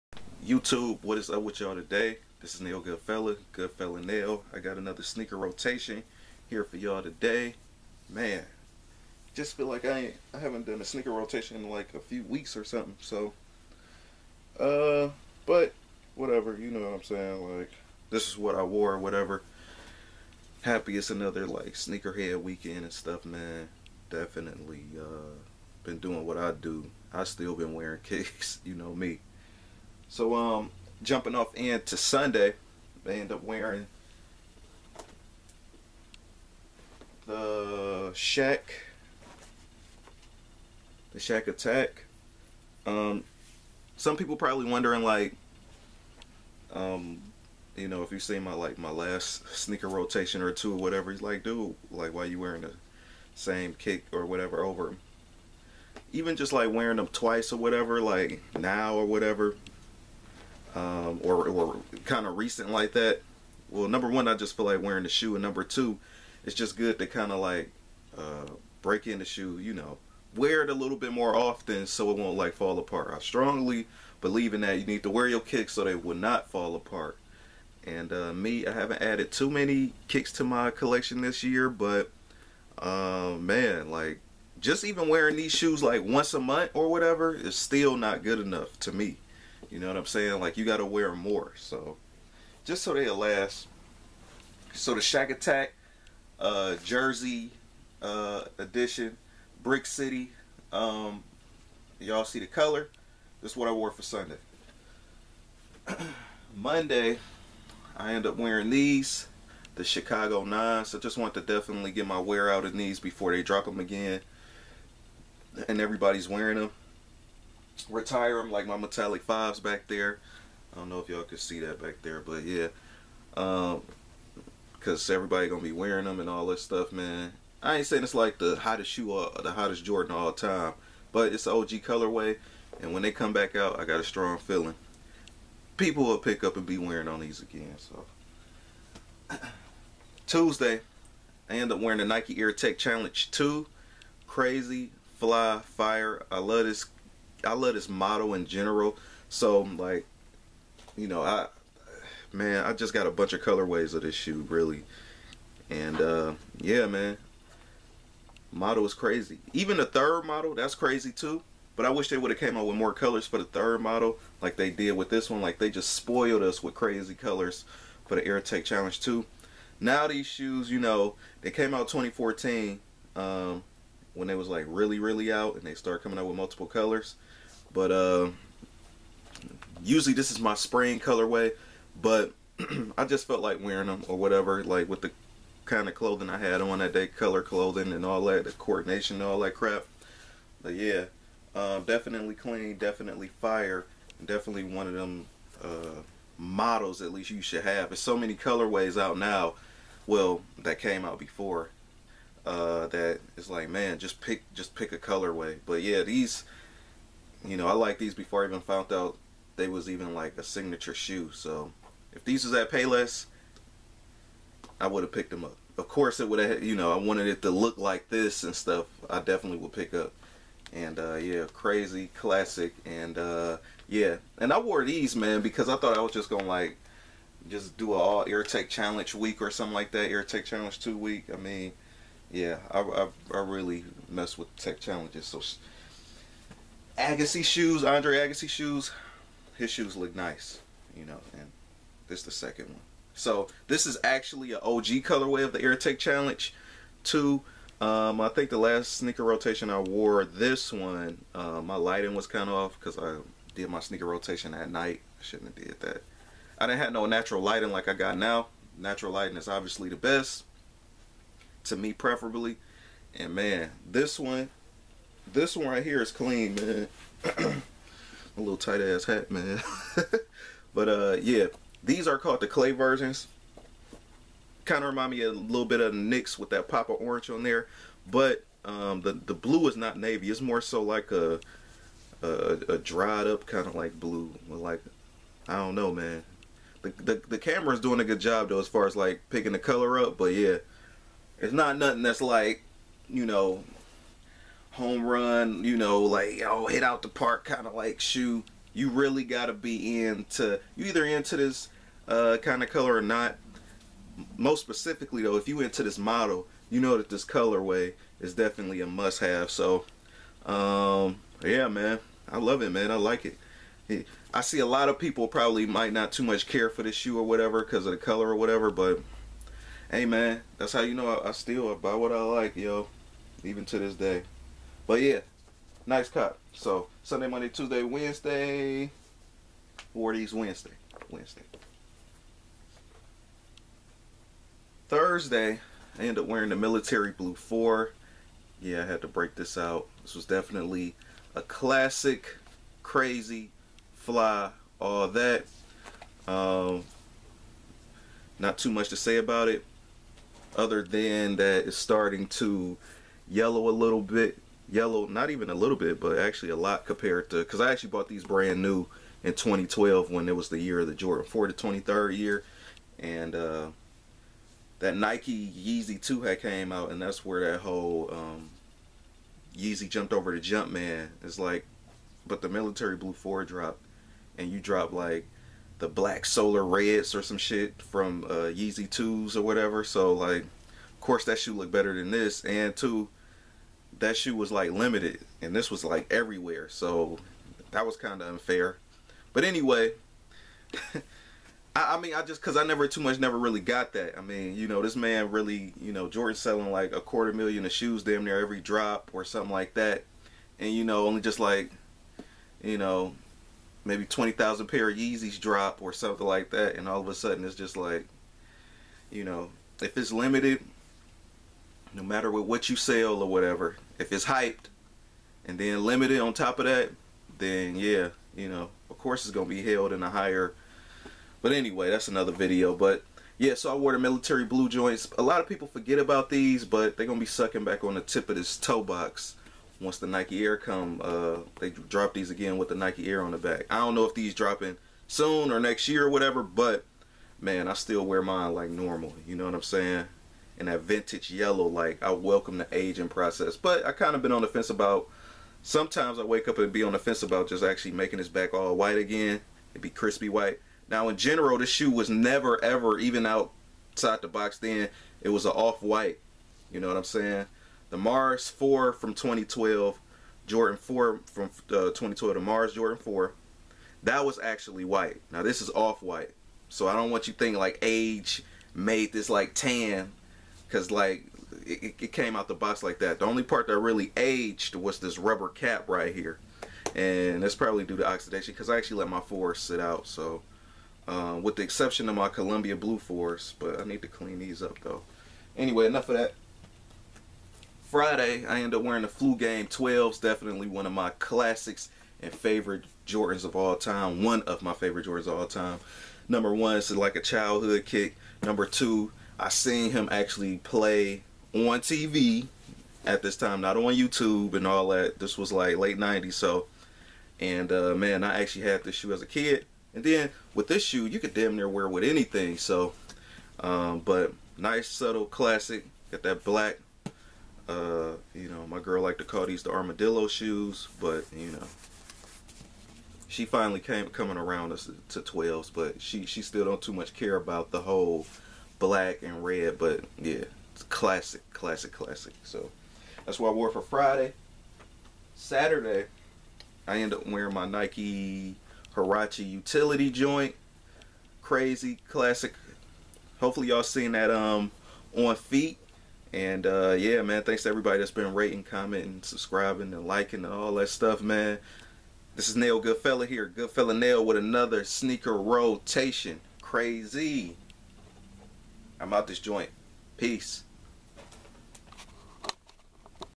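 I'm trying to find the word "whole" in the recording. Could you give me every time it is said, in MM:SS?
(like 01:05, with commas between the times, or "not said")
06:07, 08:47.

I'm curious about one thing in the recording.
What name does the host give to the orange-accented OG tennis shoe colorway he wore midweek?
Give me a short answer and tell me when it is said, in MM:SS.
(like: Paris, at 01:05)
clay versions, at 04:32.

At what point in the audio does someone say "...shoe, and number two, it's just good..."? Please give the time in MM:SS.
01:05.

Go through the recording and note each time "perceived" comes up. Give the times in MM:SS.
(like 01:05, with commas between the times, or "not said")
not said.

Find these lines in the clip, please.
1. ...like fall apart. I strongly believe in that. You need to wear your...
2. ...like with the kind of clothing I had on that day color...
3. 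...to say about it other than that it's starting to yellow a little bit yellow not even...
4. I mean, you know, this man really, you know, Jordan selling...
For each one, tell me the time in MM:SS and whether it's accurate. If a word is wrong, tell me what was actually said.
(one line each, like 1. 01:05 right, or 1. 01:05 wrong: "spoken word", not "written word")
1. 01:12 right
2. 03:04 right
3. 05:48 right
4. 06:34 right.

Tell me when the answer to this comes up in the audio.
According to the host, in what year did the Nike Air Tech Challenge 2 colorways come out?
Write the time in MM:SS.
02:51.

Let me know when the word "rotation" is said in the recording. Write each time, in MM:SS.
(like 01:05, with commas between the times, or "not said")
00:05, 00:11, 00:49, 04:09, 04:14, 09:15.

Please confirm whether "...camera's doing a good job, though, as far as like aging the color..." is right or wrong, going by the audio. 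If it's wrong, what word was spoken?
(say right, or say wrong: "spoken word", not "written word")
wrong: "picking", not "aging".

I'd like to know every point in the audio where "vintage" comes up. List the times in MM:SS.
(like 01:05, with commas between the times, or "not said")
07:20.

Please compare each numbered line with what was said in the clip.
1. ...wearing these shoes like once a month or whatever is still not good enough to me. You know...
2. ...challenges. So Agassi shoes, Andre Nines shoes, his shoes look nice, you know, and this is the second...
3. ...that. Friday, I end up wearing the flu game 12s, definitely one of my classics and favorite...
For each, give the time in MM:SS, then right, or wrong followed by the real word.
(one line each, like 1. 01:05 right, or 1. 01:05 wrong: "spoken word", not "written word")
1. 01:25 right
2. 03:54 wrong: "Agassi", not "Nines"
3. 08:06 right.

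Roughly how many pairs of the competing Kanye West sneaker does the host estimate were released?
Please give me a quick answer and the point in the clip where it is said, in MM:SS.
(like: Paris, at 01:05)
20,000, at 06:44.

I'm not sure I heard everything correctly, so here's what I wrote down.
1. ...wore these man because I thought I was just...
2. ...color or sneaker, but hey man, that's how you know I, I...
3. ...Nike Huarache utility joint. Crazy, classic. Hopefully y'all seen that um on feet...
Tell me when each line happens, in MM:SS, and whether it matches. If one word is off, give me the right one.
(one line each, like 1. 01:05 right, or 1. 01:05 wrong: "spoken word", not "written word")
1. 03:44 right
2. 05:17 wrong: "whatever", not "sneaker"
3. 08:57 right.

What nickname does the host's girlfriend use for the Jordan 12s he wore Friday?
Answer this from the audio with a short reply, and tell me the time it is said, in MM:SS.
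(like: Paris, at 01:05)
armadillo shoes, at 08:39.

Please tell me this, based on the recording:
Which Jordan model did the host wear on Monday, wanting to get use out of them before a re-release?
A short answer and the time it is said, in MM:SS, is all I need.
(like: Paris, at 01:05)
Chicago 9s, at 01:49.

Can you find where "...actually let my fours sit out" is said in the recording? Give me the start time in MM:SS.
07:58.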